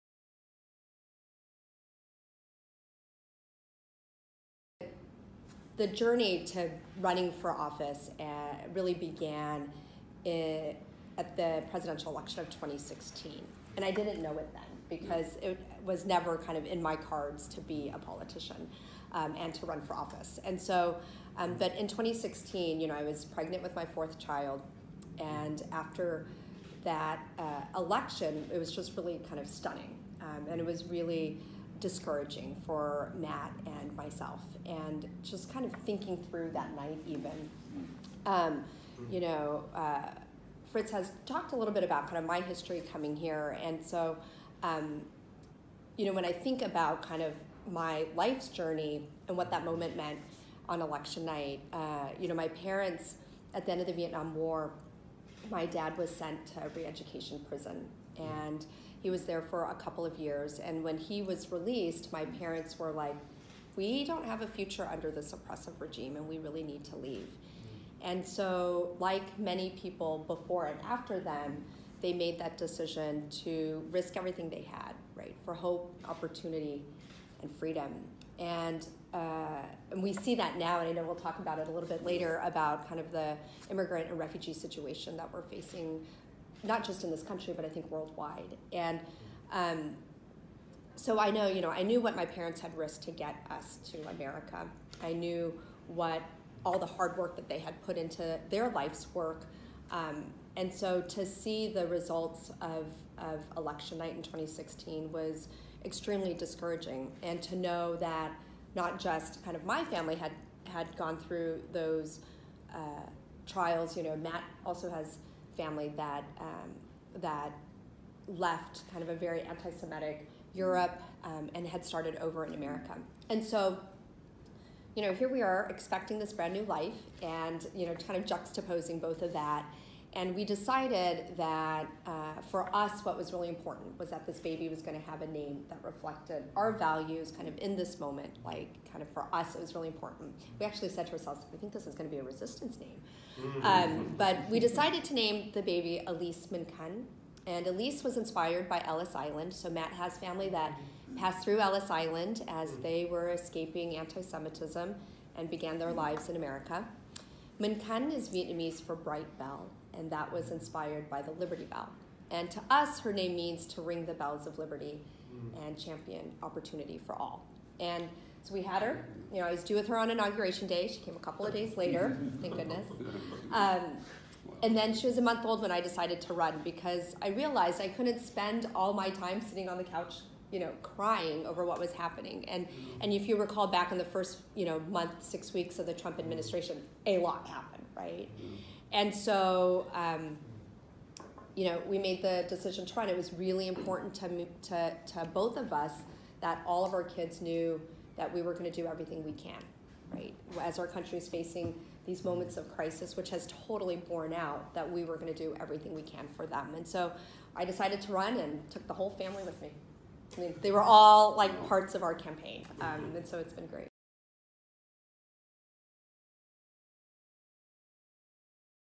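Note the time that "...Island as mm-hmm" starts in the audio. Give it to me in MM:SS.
02:31.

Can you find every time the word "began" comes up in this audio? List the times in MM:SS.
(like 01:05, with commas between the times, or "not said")
00:08, 02:35.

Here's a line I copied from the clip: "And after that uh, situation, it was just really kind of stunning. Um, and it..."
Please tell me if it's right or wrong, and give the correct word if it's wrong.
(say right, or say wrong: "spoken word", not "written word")
wrong: "election", not "situation".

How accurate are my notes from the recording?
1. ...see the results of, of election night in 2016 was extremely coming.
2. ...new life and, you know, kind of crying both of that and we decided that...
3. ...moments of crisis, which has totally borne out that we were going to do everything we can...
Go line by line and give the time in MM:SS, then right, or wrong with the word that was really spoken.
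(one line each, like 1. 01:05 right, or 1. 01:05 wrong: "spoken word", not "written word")
1. 01:41 wrong: "discouraging", not "coming"
2. 02:06 wrong: "juxtaposing", not "crying"
3. 03:22 right.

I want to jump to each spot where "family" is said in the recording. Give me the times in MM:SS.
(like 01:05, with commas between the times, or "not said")
01:49, 01:55, 02:30, 03:29.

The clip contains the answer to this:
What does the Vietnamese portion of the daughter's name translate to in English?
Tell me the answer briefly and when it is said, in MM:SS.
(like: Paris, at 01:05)
bright bell, at 02:38.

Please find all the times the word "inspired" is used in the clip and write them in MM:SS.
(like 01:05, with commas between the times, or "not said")
02:28, 02:40.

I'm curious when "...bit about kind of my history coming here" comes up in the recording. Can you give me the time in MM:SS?
00:41.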